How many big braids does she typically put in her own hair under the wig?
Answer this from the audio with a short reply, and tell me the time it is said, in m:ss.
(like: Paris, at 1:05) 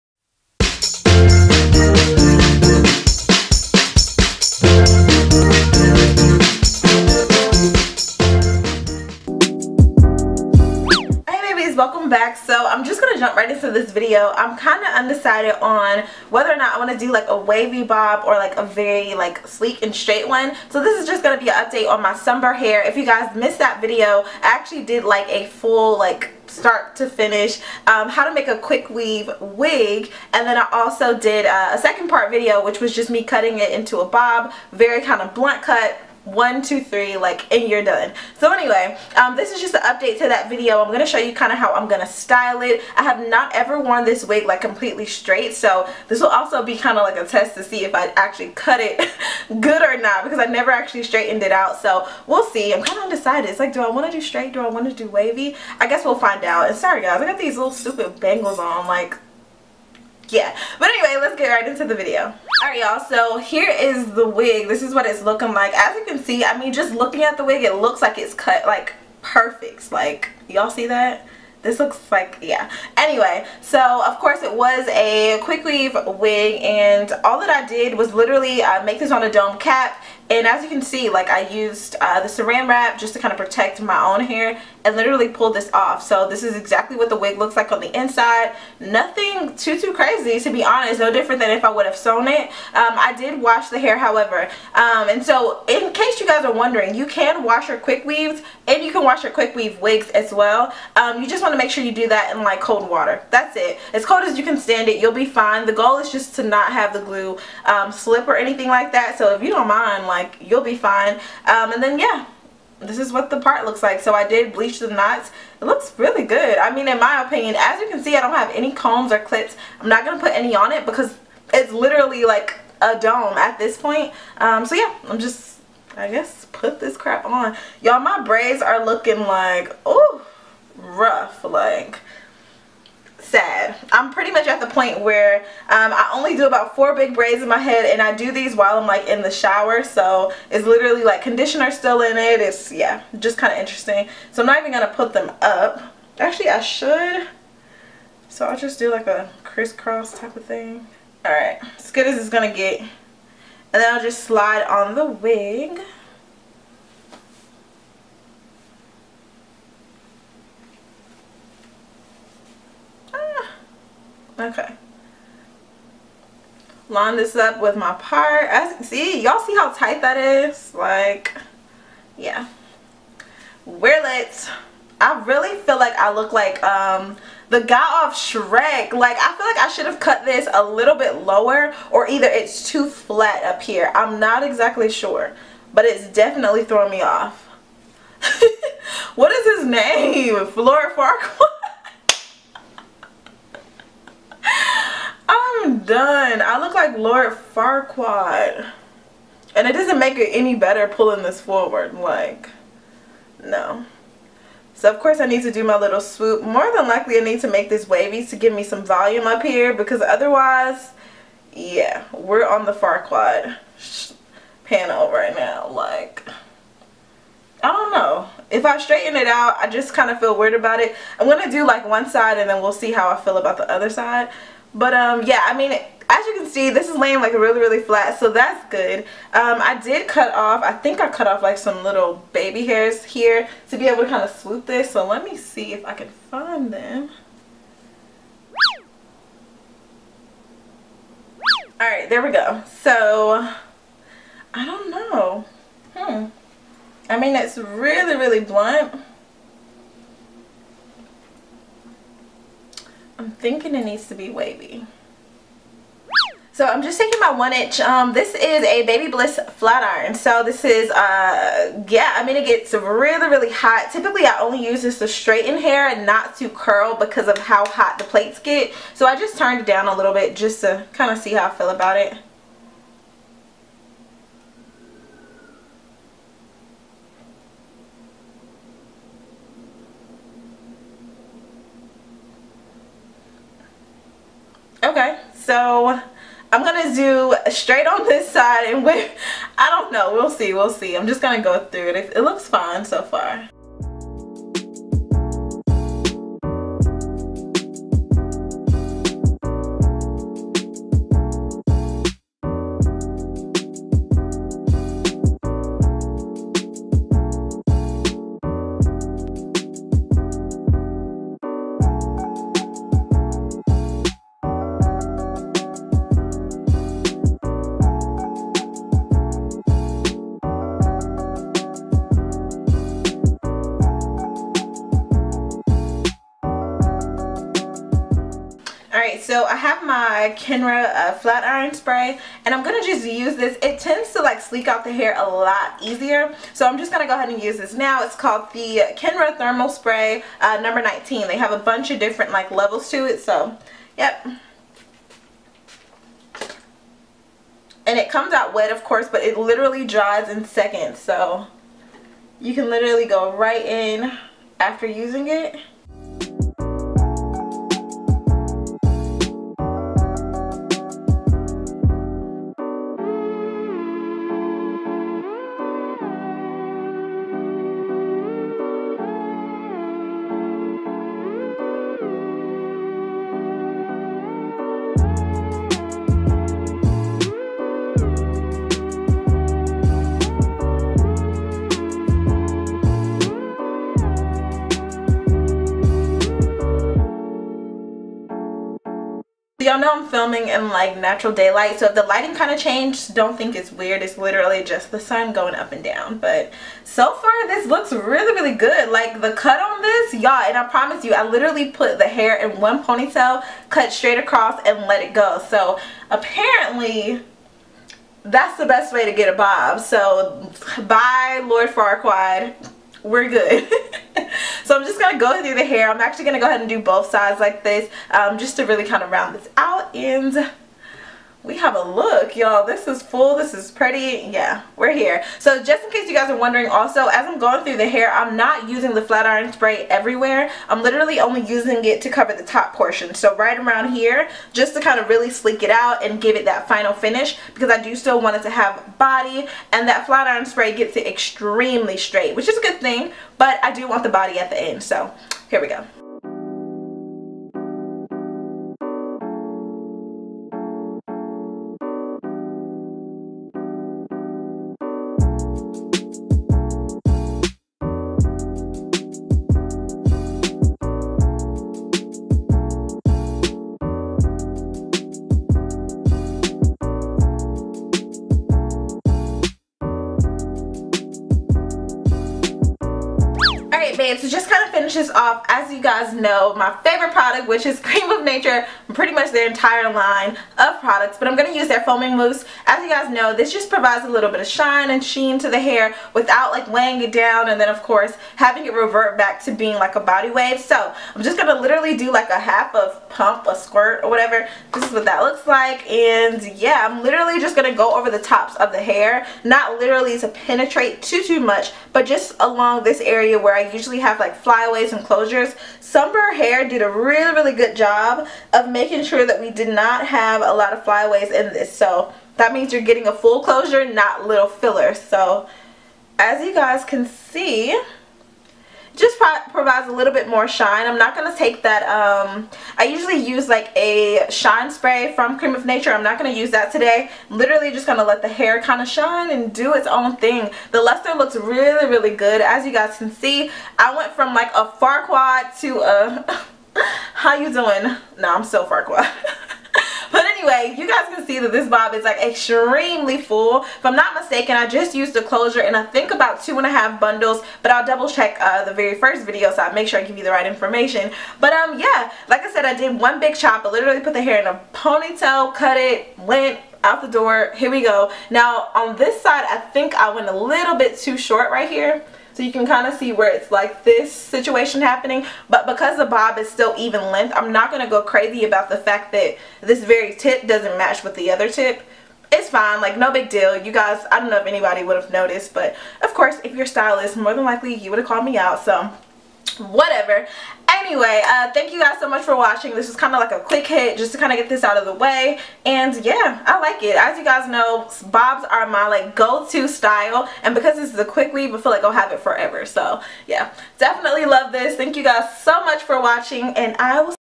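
4, at 2:16.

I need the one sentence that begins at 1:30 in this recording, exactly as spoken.
No different than if I would have sewn it.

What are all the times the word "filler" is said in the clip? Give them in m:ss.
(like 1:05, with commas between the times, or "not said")
8:34.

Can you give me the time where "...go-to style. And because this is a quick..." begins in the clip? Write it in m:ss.
9:49.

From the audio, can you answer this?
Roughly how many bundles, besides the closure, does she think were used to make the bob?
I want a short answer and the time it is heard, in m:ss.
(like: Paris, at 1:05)
2.5, at 9:06.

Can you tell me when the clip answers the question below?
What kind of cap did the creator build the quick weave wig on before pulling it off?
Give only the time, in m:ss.
1:19.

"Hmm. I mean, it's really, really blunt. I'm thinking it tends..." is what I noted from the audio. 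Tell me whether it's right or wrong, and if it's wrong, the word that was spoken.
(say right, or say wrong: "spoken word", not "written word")
wrong: "needs", not "tends".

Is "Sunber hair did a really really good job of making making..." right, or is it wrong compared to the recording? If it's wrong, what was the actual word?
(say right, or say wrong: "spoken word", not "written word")
right.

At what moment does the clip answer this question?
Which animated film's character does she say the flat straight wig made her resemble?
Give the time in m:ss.
2:58.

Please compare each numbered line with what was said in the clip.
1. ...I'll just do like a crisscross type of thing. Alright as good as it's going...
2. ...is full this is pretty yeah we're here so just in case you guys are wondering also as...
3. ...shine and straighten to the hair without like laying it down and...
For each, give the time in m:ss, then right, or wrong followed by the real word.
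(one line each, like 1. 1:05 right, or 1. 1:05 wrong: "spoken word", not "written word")
1. 2:28 right
2. 7:02 right
3. 8:04 wrong: "sheen", not "straighten".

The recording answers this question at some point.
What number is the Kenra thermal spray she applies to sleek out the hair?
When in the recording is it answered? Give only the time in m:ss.
5:40.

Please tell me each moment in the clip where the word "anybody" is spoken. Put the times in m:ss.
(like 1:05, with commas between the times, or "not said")
9:34.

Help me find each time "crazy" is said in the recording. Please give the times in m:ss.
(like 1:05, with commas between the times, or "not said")
1:29, 9:28.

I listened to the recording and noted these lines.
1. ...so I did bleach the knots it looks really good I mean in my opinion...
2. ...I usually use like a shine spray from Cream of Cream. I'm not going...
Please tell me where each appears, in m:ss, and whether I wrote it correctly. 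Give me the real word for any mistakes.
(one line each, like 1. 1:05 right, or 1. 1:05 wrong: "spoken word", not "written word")
1. 1:54 right
2. 8:42 wrong: "Nature", not "Cream".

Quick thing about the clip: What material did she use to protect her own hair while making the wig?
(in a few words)
Saran wrap.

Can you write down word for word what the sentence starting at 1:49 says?
So if you don't mind, like, you'll be fine.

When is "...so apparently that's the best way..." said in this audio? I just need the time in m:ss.
6:45.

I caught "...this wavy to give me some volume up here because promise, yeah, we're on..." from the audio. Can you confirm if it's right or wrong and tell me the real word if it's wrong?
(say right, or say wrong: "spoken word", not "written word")
wrong: "otherwise", not "promise".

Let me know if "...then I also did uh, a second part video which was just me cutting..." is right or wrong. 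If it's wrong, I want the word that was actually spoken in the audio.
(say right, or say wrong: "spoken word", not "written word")
right.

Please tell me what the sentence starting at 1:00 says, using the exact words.
But anyway, let's get right into the video.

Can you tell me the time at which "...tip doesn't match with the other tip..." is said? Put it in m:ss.
9:30.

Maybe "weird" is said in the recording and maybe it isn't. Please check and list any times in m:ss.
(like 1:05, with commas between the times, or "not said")
3:40, 6:33.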